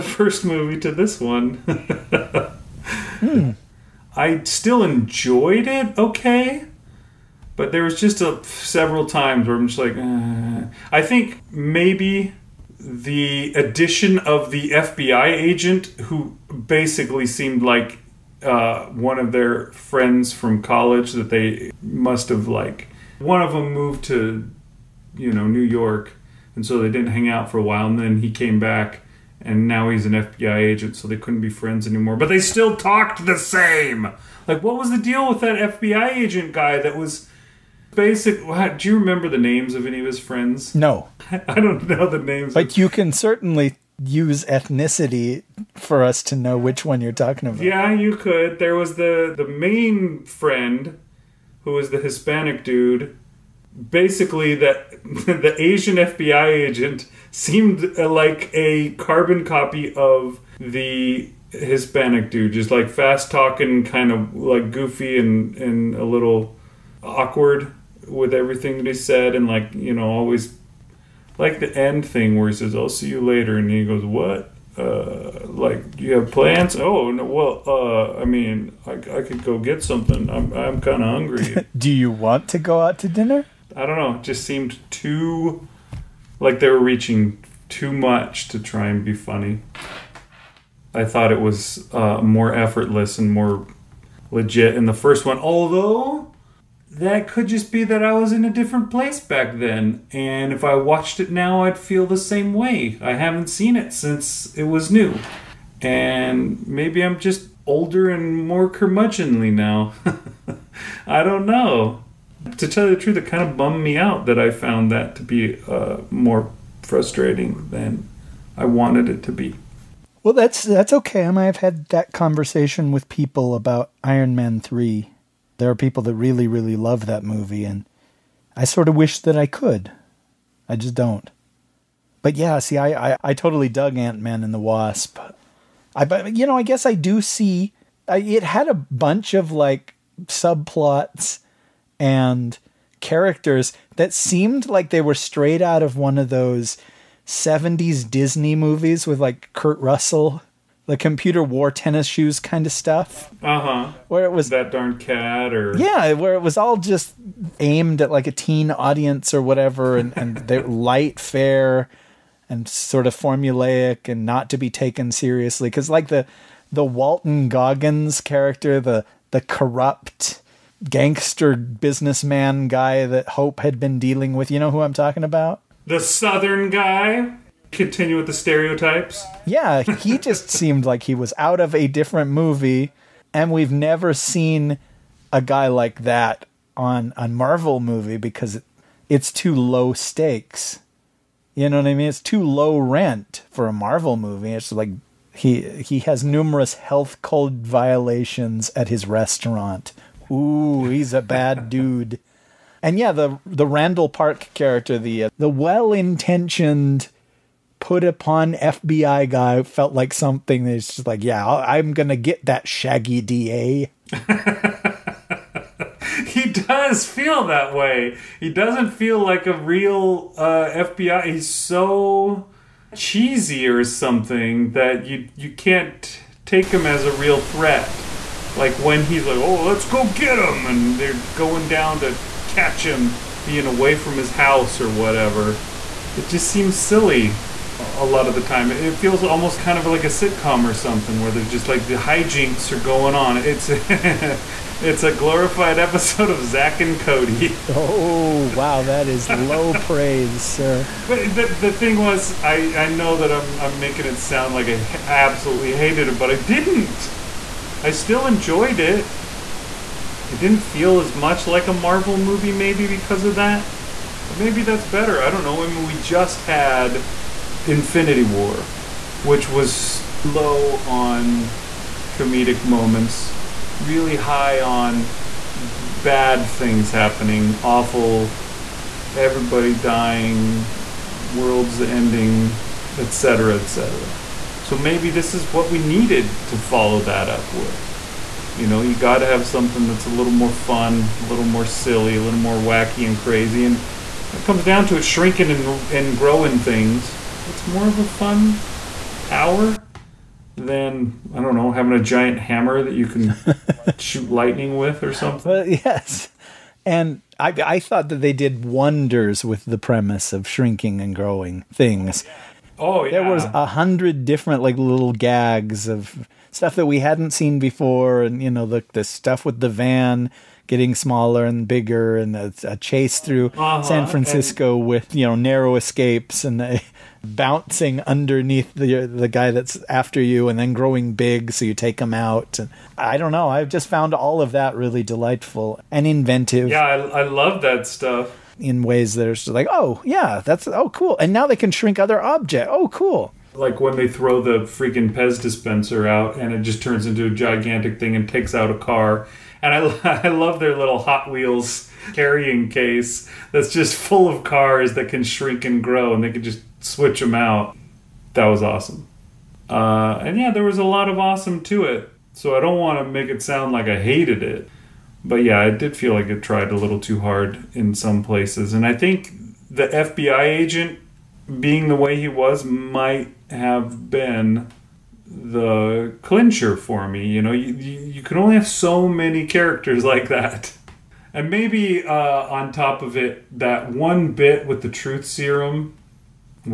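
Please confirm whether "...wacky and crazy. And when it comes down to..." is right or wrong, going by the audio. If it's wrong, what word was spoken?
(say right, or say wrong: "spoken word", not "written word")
right.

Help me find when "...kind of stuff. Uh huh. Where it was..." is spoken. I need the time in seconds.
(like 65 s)
152 s.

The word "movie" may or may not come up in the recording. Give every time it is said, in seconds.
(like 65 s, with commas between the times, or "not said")
0 s, 127 s, 148 s, 182 s, 187 s, 194 s, 262 s.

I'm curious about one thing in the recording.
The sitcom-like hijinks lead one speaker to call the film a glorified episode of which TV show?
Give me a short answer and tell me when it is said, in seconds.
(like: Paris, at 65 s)
Zack and Cody, at 246 s.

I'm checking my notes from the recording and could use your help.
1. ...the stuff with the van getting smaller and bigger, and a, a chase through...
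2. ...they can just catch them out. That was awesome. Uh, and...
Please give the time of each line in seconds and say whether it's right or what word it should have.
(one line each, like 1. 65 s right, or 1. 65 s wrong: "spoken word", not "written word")
1. 318 s right
2. 356 s wrong: "switch", not "catch".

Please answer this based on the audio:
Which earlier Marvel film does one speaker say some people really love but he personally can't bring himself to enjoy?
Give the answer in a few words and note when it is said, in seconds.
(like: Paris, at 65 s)
Iron Man 3, at 124 s.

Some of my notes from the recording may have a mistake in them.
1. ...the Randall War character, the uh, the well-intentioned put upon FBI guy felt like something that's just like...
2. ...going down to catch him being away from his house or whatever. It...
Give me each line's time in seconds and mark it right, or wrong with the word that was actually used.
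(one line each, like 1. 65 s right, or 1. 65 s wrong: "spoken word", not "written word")
1. 203 s wrong: "Park", not "War"
2. 231 s right.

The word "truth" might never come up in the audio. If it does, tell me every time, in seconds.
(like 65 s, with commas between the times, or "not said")
113 s, 384 s.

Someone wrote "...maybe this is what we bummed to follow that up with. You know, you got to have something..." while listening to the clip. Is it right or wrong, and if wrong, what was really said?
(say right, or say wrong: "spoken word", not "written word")
wrong: "needed", not "bummed".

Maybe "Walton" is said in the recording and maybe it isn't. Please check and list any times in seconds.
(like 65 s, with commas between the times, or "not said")
166 s.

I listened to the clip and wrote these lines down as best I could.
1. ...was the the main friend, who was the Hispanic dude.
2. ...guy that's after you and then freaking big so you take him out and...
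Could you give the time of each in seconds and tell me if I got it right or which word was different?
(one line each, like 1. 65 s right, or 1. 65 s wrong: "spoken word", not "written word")
1. 48 s right
2. 329 s wrong: "growing", not "freaking".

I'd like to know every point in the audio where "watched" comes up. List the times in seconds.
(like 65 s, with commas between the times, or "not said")
100 s.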